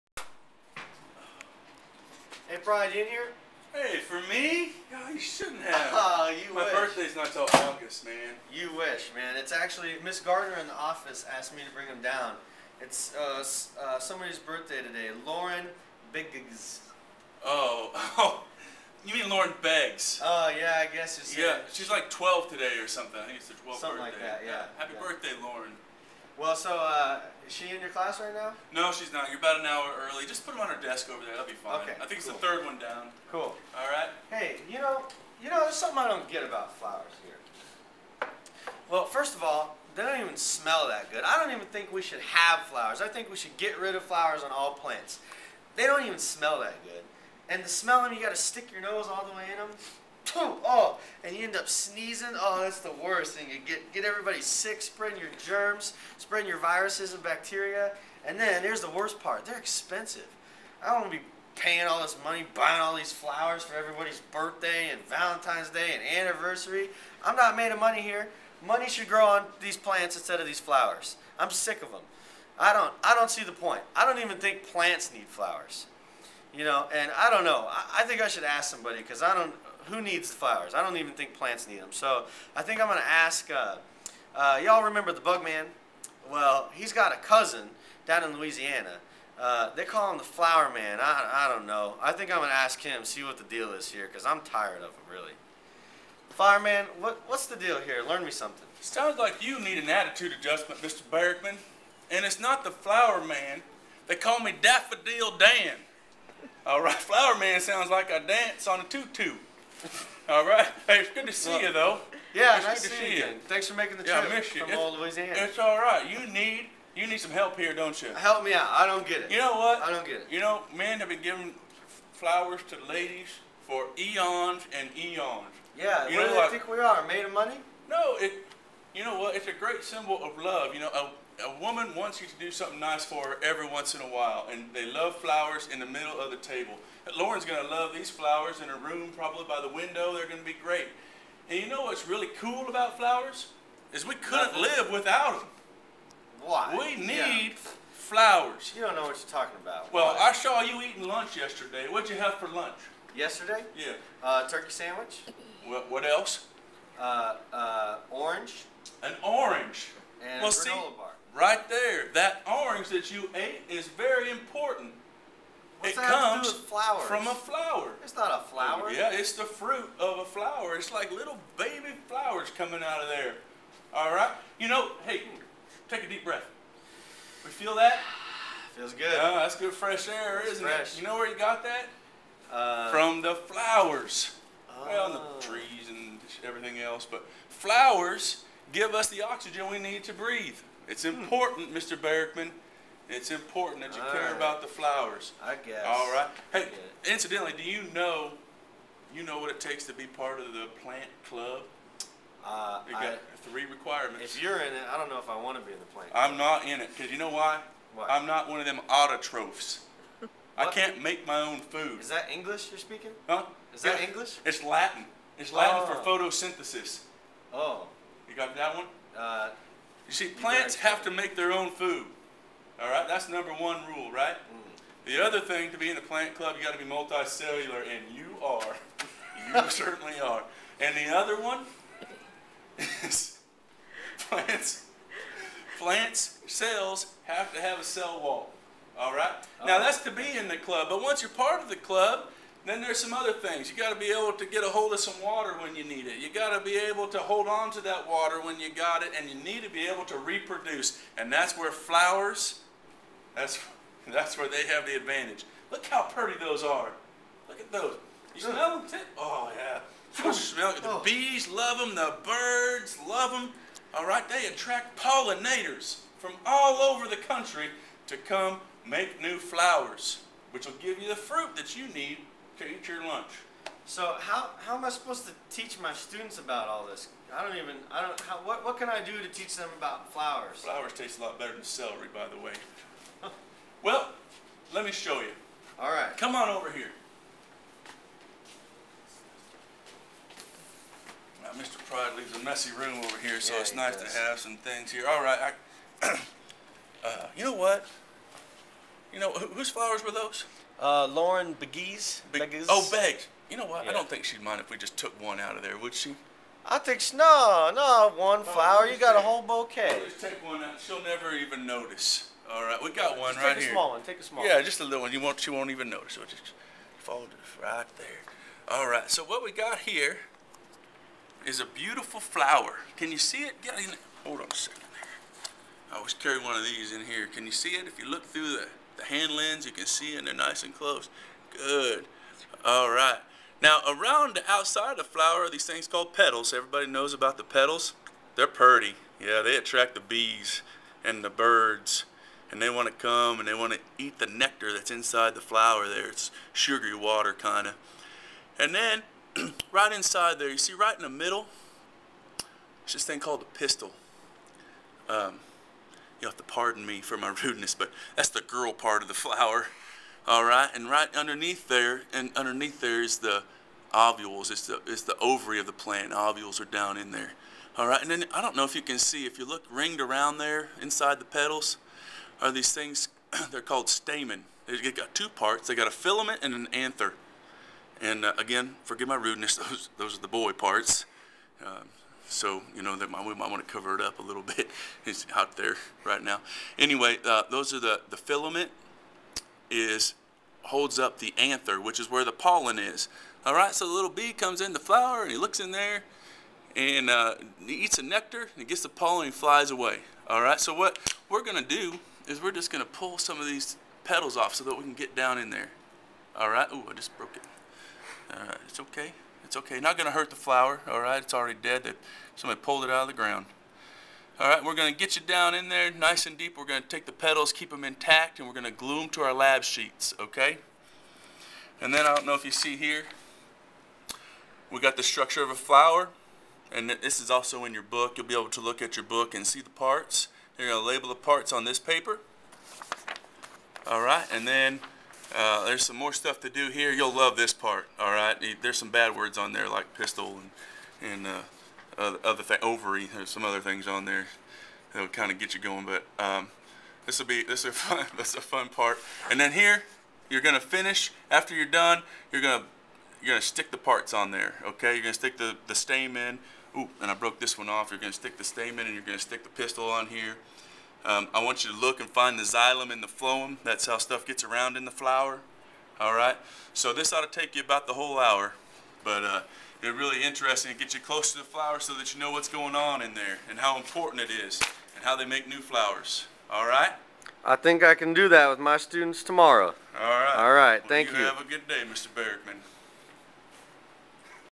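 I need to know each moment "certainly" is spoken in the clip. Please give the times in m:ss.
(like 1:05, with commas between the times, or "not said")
3:49.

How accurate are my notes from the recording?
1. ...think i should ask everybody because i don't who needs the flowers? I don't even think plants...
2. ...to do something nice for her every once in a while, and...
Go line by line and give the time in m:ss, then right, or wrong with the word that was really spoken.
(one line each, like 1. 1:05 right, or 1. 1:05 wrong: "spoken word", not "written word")
1. 1:18 wrong: "somebody", not "everybody"
2. 2:12 right.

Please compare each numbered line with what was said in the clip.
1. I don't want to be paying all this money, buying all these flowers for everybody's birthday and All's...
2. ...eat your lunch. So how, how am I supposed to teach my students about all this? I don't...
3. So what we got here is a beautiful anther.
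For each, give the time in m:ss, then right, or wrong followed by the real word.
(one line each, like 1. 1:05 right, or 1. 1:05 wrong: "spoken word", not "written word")
1. 1:00 wrong: "Valentine", not "All"
2. 4:32 right
3. 5:19 wrong: "flower", not "anther".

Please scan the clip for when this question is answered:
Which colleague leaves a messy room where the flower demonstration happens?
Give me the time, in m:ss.
4:51.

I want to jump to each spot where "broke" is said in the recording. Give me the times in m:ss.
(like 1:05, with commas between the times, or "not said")
6:47, 7:37.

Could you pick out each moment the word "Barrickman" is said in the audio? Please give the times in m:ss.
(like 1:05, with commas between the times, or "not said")
1:41.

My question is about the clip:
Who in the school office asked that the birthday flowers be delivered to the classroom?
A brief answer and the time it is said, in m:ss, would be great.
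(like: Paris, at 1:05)
Miss Gardner, at 0:10.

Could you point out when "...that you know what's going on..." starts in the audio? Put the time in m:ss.
7:51.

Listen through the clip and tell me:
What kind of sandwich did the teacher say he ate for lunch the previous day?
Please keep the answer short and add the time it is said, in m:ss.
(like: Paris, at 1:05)
Turkey, at 2:34.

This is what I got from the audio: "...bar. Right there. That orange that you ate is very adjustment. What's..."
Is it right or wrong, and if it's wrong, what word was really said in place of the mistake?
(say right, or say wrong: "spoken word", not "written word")
wrong: "important", not "adjustment".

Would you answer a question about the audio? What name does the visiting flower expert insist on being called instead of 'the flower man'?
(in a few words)
Daffodil Dan.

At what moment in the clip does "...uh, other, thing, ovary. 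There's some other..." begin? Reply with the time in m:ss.
7:21.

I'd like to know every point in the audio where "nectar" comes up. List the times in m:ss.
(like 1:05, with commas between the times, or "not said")
5:44, 6:38.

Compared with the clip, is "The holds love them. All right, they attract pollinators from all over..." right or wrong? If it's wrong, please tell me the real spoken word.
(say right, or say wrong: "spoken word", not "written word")
wrong: "birds", not "holds".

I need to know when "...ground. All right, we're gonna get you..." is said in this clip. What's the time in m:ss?
6:53.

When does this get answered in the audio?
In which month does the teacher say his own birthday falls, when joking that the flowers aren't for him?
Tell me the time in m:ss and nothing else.
0:07.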